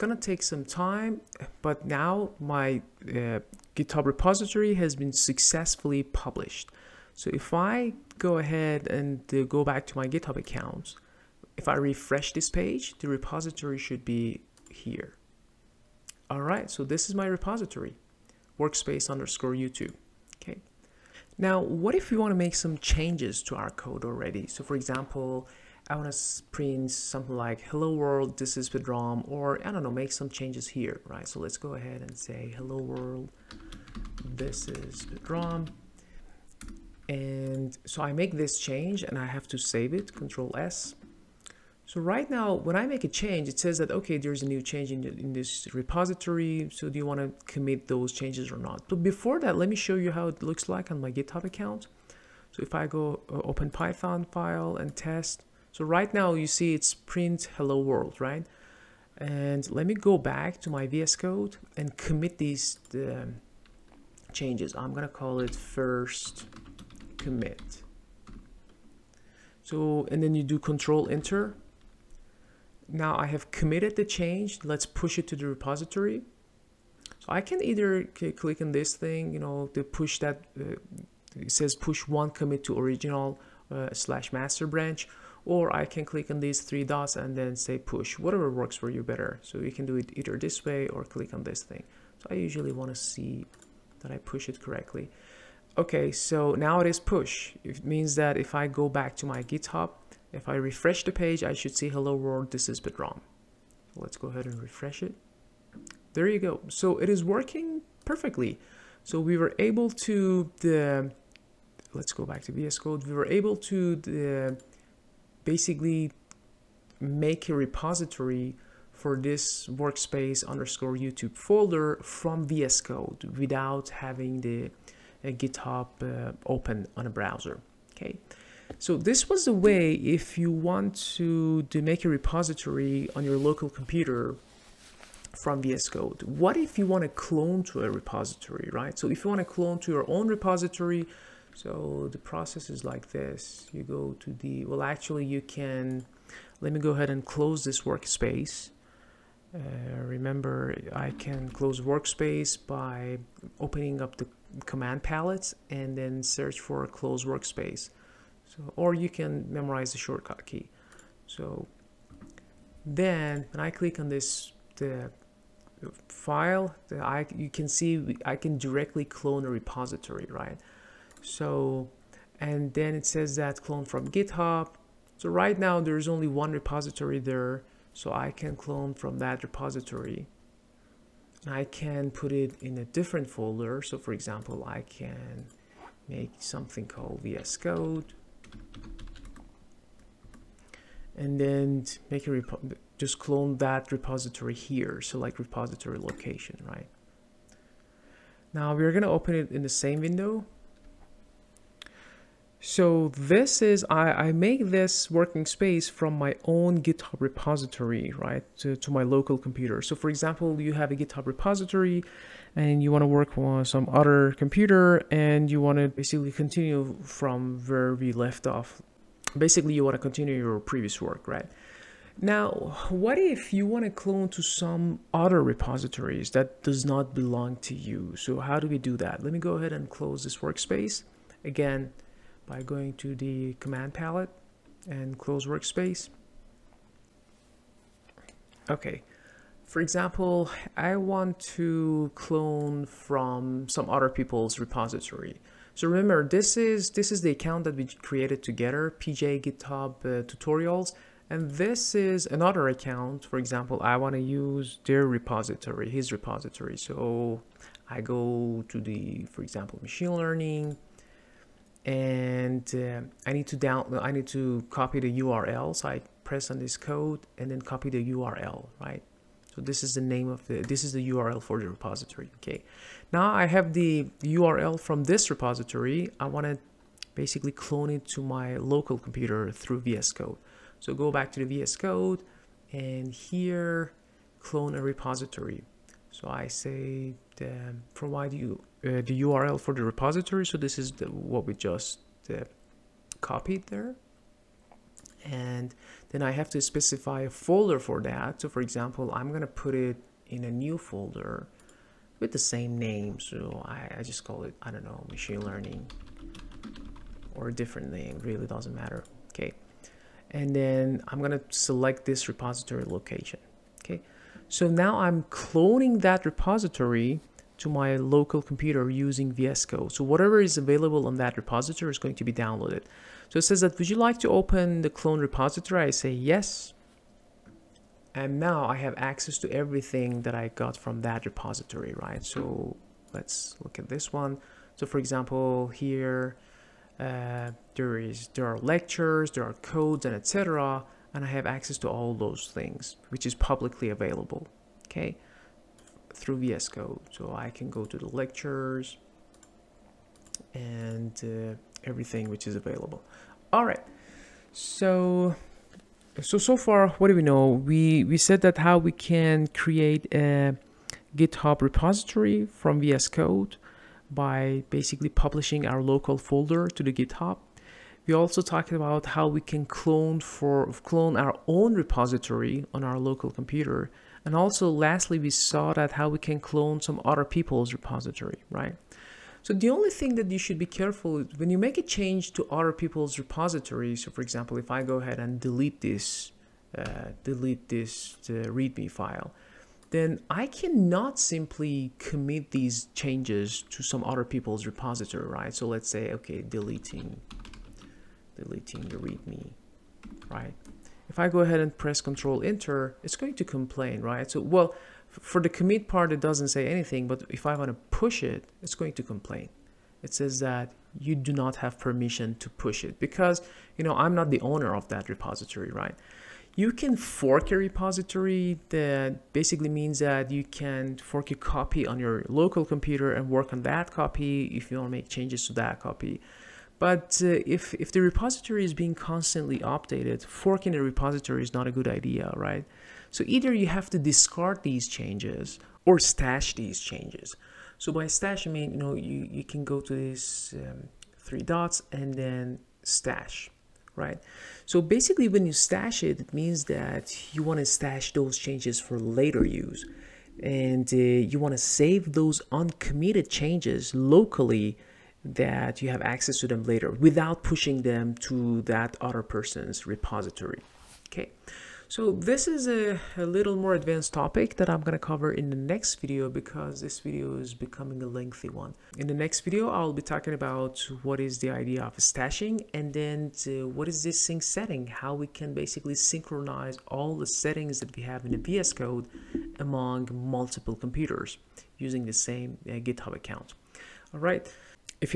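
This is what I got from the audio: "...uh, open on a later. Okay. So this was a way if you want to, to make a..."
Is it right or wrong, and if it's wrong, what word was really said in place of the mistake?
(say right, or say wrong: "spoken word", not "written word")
wrong: "browser", not "later".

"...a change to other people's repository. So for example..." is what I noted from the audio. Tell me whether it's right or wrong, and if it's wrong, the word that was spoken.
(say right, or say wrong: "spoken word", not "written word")
right.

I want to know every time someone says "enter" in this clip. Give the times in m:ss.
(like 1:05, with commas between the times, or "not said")
1:11, 6:42.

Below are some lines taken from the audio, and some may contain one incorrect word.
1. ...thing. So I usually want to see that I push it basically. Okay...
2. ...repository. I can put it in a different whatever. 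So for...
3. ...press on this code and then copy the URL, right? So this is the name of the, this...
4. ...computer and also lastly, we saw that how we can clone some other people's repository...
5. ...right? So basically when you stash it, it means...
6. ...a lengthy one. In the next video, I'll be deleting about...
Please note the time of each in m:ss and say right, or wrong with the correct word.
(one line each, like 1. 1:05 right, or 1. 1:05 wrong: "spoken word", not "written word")
1. 1:31 wrong: "correctly", not "basically"
2. 2:59 wrong: "folder", not "whatever"
3. 4:26 right
4. 6:13 right
5. 7:23 right
6. 7:48 wrong: "talking", not "deleting".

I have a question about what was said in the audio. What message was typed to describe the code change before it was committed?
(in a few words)
first commit.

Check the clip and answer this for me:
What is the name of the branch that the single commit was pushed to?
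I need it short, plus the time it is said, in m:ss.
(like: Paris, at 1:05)
master, at 1:24.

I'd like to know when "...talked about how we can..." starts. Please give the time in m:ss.
6:08.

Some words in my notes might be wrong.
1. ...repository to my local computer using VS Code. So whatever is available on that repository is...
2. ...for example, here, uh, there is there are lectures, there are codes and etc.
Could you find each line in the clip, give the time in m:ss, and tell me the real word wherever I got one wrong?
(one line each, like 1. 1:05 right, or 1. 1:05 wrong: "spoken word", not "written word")
1. 5:16 right
2. 5:34 right.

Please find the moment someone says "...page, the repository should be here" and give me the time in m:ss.
0:12.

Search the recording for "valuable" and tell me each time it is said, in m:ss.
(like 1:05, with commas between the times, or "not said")
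not said.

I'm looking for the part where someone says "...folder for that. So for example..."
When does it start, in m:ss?
4:57.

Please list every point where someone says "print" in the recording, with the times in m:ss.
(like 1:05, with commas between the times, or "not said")
0:26, 0:56.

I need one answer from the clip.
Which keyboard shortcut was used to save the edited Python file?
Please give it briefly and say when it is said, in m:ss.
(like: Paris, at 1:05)
Control S, at 0:40.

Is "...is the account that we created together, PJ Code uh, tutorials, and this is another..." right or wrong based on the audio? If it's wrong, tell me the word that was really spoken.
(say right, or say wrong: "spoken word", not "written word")
wrong: "GitHub", not "Code".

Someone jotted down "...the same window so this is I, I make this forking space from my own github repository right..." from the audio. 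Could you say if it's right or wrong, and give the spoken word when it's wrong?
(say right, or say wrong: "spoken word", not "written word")
wrong: "working", not "forking".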